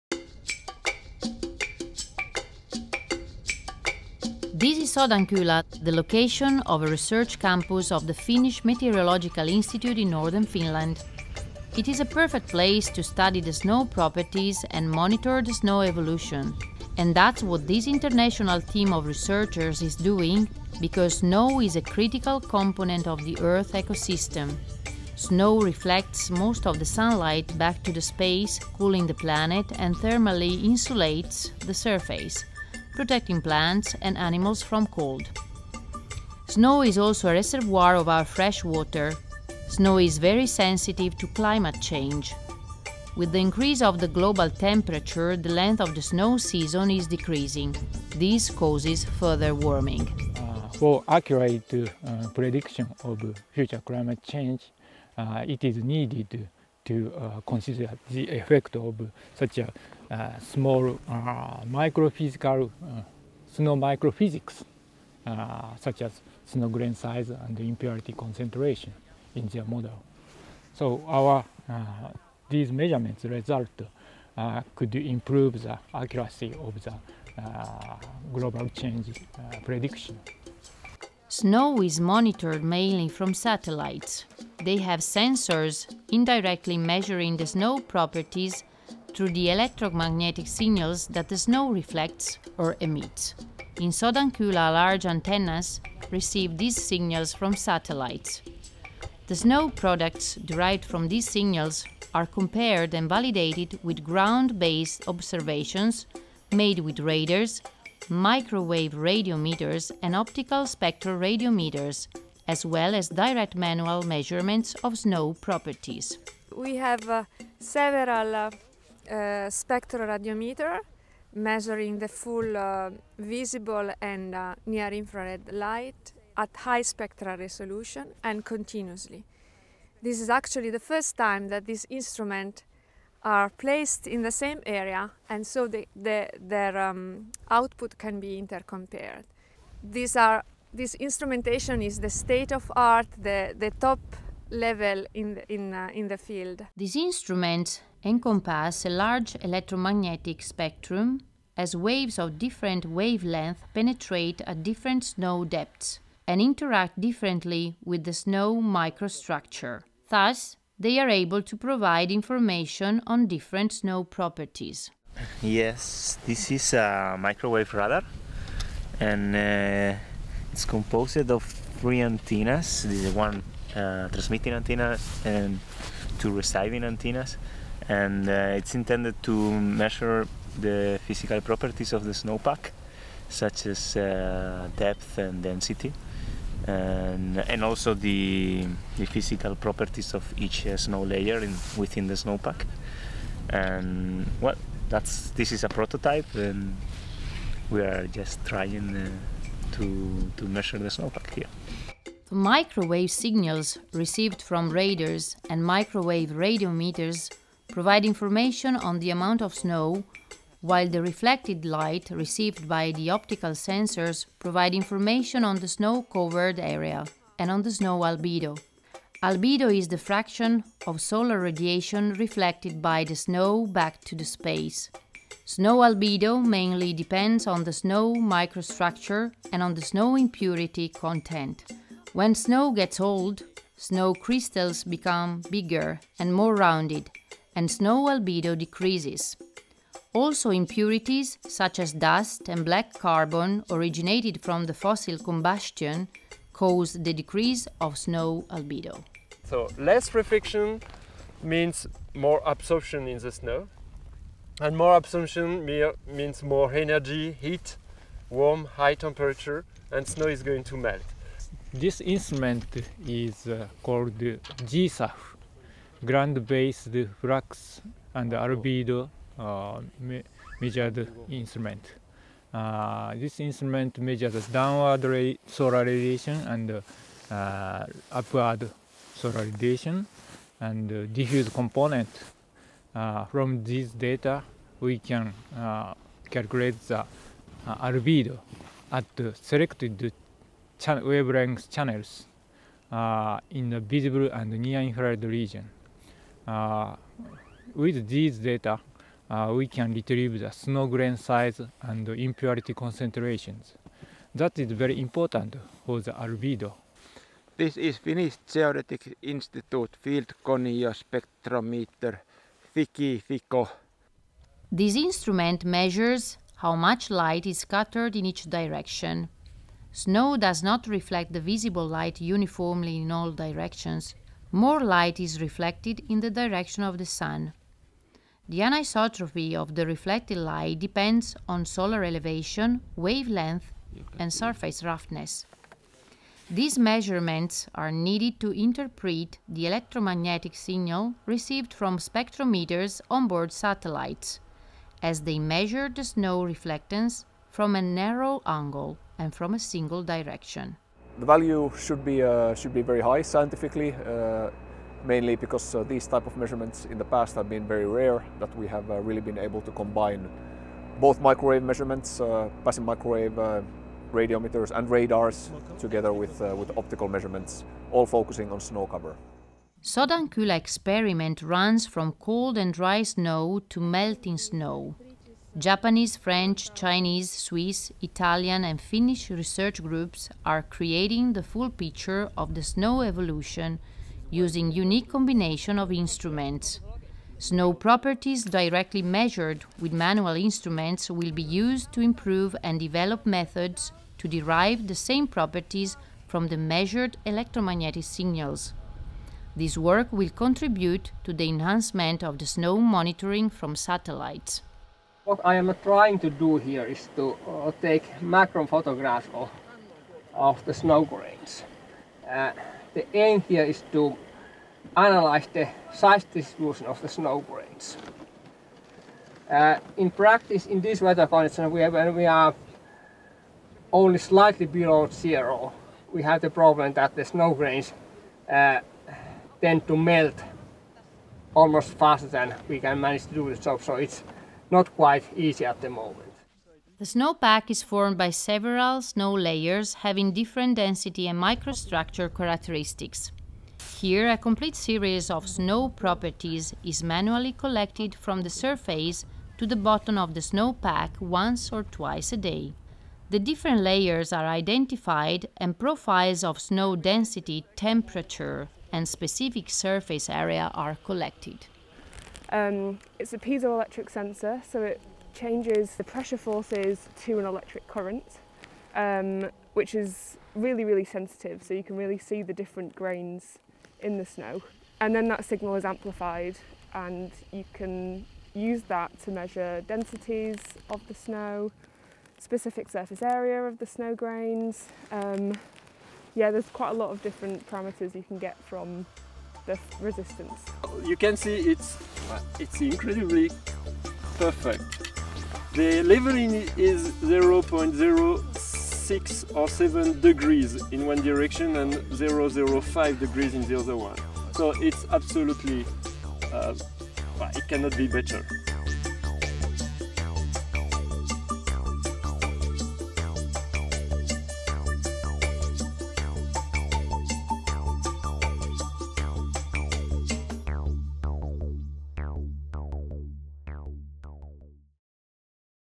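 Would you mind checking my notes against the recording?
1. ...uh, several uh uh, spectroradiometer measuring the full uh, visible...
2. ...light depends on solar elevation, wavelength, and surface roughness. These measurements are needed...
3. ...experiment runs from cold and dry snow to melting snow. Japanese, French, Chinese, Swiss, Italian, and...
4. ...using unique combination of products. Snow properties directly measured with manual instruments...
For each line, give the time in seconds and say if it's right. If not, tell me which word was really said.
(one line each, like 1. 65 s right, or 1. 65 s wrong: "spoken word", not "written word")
1. 117 s right
2. 330 s right
3. 370 s right
4. 384 s wrong: "instruments", not "products".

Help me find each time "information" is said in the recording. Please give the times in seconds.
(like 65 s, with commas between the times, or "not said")
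162 s, 208 s, 214 s.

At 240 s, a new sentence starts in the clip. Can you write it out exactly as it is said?
Also impurities such as dust and black carbon originated from the fossil combustion cause the decrease of snow albedo.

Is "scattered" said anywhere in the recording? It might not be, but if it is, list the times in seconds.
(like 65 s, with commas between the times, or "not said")
317 s.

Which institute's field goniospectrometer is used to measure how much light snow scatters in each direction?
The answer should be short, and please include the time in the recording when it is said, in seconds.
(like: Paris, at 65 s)
Finnish Geodetic Institute, at 307 s.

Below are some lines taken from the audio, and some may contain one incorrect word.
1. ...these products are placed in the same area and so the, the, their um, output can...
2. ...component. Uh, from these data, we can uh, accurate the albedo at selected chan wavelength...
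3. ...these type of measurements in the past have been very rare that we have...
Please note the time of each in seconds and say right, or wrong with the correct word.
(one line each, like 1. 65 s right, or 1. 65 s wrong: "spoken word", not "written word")
1. 131 s wrong: "instruments", not "products"
2. 281 s wrong: "calculate", not "accurate"
3. 355 s right.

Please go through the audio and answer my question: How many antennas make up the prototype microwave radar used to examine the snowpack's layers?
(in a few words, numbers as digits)
3.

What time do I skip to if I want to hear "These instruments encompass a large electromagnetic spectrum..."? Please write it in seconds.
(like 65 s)
146 s.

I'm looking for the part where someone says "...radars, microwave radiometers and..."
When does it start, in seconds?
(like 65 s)
106 s.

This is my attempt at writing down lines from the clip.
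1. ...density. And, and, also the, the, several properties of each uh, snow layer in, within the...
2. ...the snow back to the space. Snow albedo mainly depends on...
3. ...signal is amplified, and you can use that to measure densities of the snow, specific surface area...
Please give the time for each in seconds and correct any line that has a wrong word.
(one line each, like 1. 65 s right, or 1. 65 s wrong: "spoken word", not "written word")
1. 185 s wrong: "physical", not "several"
2. 223 s right
3. 475 s right.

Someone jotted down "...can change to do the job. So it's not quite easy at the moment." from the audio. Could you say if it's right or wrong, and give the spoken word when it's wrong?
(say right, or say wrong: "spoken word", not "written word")
wrong: "manage", not "change".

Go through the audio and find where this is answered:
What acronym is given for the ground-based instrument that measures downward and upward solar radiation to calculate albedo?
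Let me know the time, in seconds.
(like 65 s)
264 s.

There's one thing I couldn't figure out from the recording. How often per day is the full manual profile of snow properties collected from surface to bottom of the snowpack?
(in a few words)
once or twice.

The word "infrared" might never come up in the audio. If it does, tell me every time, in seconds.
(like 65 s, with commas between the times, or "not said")
124 s, 294 s.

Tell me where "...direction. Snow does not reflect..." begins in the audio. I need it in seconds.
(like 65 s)
318 s.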